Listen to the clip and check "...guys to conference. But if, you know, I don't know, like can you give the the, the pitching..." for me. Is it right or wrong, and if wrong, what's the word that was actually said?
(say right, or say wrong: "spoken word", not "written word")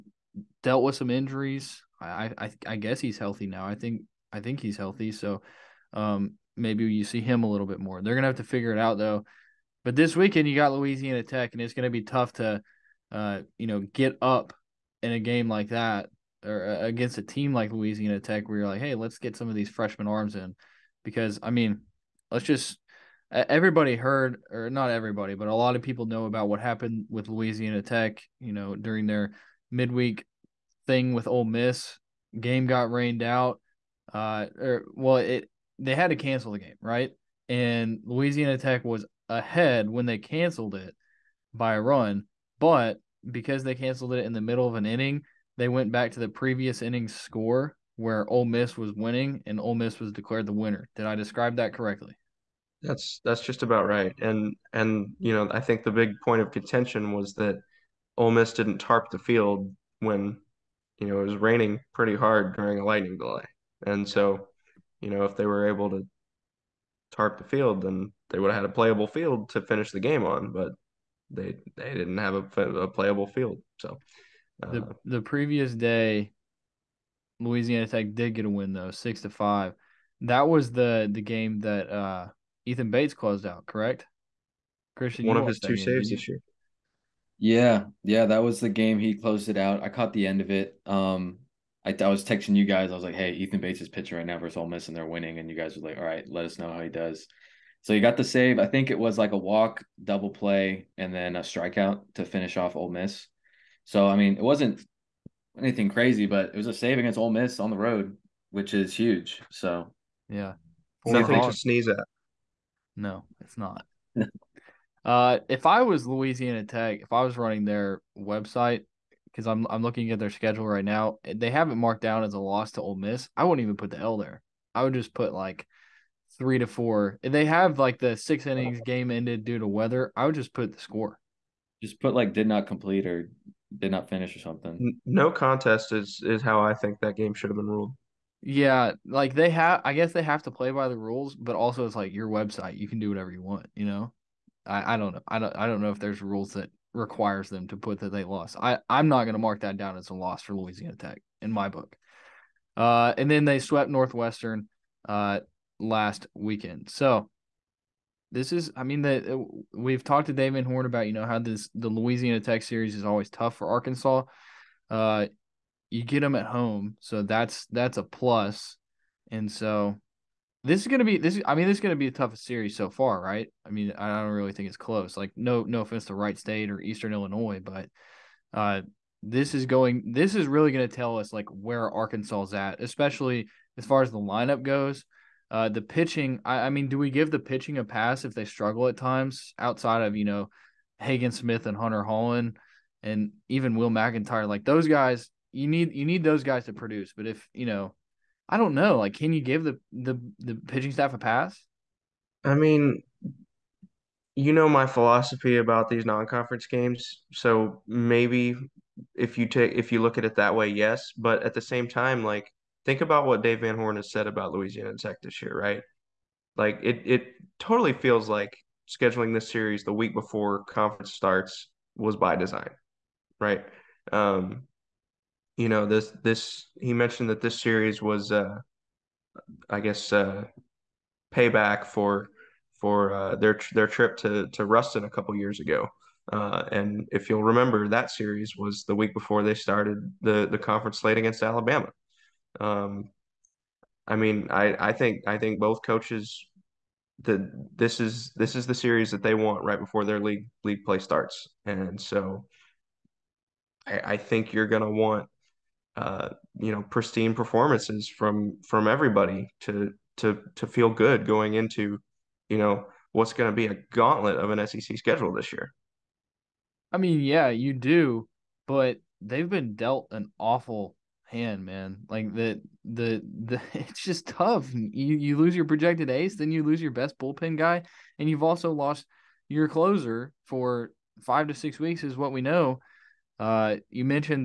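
wrong: "produce", not "conference".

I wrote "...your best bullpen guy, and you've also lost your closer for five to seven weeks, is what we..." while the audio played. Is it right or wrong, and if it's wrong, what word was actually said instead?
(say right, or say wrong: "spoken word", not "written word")
wrong: "six", not "seven".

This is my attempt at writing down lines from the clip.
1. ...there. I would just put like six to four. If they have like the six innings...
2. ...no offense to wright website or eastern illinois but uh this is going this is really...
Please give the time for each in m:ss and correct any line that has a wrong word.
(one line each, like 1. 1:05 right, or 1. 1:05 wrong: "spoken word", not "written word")
1. 2:04 wrong: "three", not "six"
2. 2:55 wrong: "state", not "website".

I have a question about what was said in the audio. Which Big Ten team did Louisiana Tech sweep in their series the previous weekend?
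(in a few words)
Northwestern.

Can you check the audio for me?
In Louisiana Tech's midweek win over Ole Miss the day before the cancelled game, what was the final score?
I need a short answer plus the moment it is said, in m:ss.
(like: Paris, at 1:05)
6-5, at 1:18.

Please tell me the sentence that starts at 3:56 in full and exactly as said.
Uh, and if you'll remember, that series was the week before they started the the conference slate against Alabama.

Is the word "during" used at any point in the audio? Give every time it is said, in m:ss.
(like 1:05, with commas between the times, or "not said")
0:28, 1:02.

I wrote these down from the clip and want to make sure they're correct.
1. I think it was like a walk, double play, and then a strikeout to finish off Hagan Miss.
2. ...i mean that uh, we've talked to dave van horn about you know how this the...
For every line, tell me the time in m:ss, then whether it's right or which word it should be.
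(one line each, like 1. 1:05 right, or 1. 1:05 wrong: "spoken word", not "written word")
1. 1:38 wrong: "Ole", not "Hagan"
2. 2:38 right.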